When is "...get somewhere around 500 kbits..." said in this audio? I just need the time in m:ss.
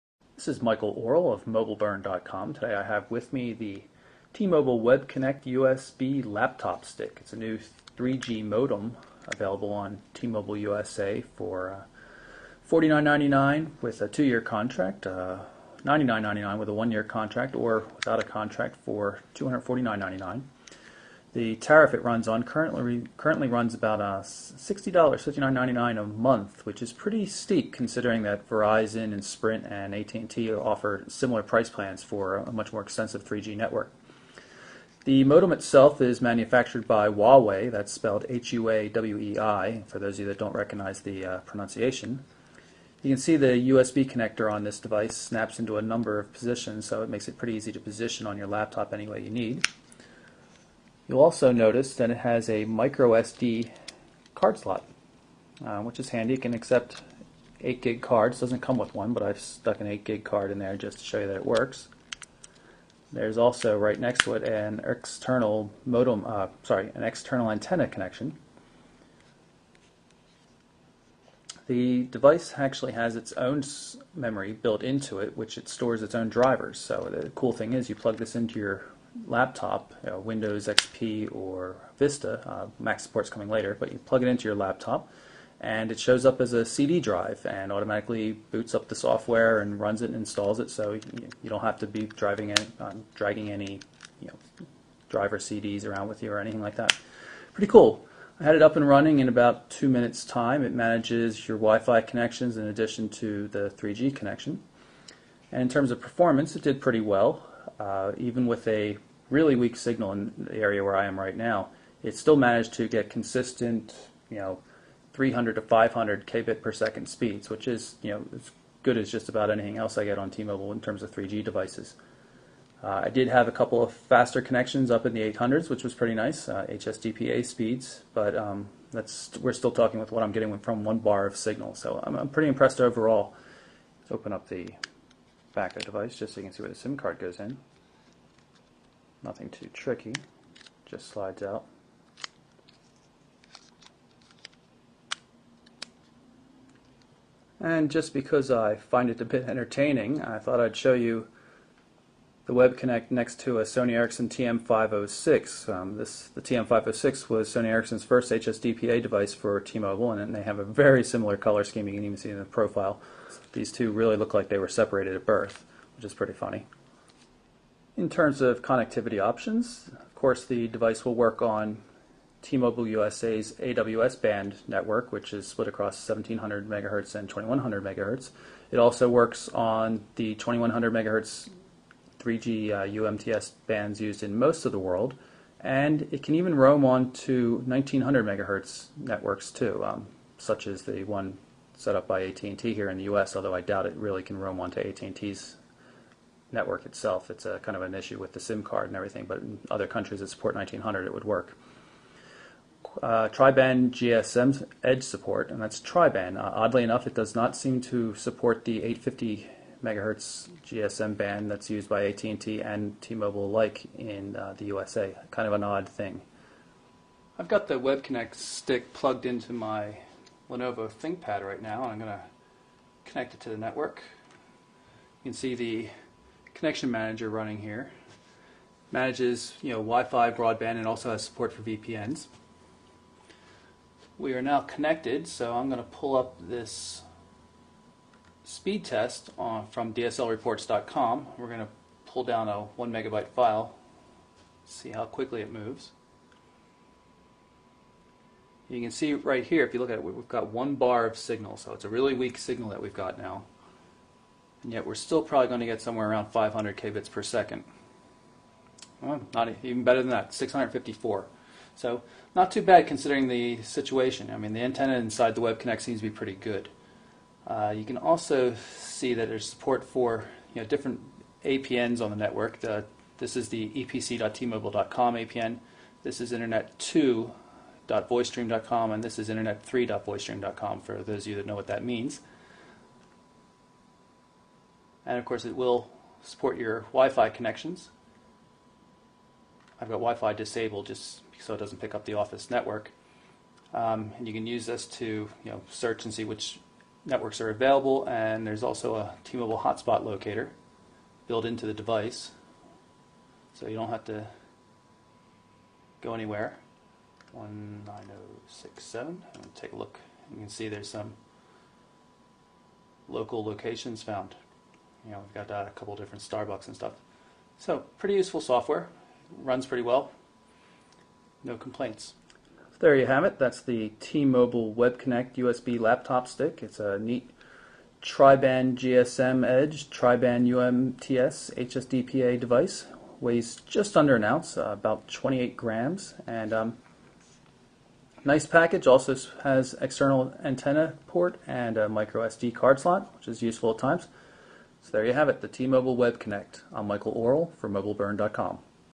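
4:15.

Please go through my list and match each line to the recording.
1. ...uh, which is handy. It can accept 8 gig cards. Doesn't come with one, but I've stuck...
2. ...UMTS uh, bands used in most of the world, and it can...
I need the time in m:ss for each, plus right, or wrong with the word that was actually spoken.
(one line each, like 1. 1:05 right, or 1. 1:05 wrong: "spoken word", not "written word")
1. 0:55 right
2. 3:02 right.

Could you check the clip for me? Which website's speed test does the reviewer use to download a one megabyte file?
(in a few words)
dslreports.com.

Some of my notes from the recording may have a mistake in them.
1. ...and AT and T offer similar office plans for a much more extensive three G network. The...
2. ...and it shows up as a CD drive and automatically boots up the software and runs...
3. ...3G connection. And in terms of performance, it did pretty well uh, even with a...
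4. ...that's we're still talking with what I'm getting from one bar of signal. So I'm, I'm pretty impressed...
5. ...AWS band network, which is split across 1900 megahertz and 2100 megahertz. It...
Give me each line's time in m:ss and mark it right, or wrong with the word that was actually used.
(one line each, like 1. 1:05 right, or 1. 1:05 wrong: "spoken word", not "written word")
1. 0:29 wrong: "price", not "office"
2. 1:25 right
3. 1:43 right
4. 2:08 right
5. 2:53 wrong: "1700", not "1900".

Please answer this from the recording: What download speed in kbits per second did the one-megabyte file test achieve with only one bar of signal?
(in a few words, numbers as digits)
654.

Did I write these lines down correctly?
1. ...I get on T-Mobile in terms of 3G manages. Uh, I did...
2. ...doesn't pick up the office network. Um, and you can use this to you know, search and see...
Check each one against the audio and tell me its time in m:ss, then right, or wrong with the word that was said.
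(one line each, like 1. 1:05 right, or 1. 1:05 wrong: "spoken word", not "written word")
1. 1:59 wrong: "devices", not "manages"
2. 4:51 right.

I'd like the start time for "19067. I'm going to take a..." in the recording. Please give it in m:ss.
5:07.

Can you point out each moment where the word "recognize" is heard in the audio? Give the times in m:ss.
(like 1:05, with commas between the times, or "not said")
0:40.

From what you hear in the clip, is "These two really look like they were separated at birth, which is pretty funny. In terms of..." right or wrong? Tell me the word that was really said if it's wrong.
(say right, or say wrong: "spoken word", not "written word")
right.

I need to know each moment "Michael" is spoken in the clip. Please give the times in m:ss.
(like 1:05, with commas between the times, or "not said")
0:00, 5:46.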